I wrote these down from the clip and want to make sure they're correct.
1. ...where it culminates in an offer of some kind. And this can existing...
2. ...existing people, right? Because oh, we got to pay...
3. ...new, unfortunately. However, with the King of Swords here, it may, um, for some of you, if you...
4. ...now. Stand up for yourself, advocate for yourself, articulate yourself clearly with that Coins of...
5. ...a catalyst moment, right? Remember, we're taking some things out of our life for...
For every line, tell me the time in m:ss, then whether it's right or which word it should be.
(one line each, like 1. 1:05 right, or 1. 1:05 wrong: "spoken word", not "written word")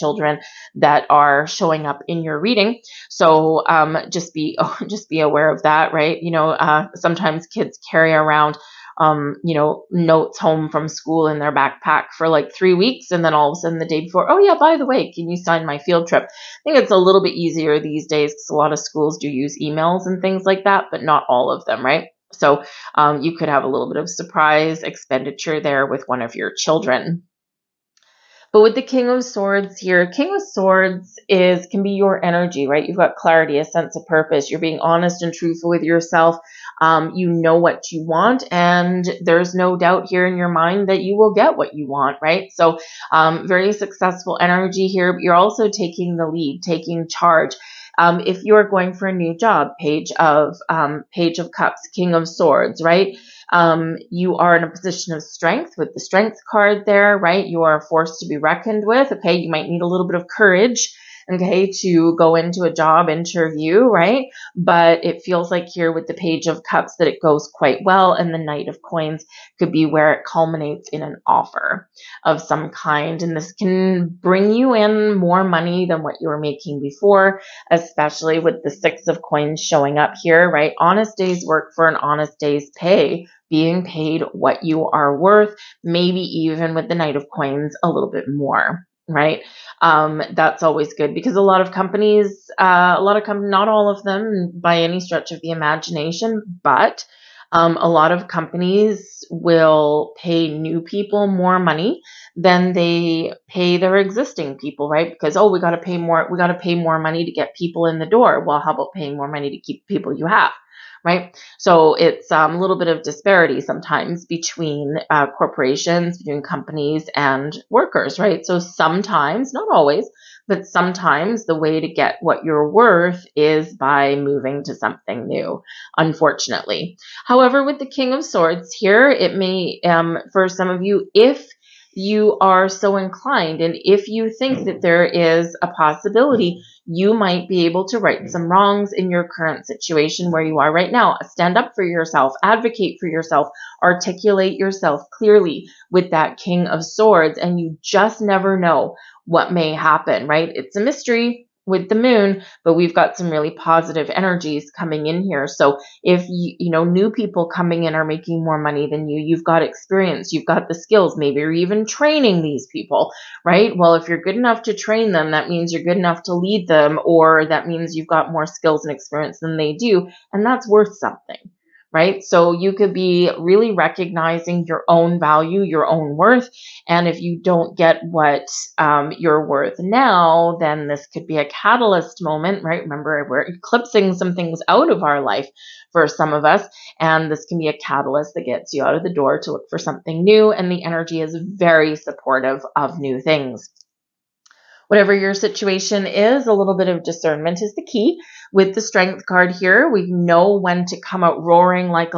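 1. 1:09 wrong: "bring", not "existing"
2. 1:43 right
3. 2:05 right
4. 2:20 wrong: "King", not "Coins"
5. 3:01 wrong: "eclipsing", not "taking".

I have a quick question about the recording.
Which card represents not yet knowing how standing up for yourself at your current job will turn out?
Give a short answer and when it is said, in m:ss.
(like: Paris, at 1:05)
the Moon, at 2:31.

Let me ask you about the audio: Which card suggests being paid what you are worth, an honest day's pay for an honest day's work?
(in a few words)
Six of Coins.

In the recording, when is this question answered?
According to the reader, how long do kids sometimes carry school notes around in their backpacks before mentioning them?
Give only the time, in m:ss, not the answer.
0:12.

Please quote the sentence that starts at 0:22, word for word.
So um, you could have a little bit of surprise expenditure there with one of your children.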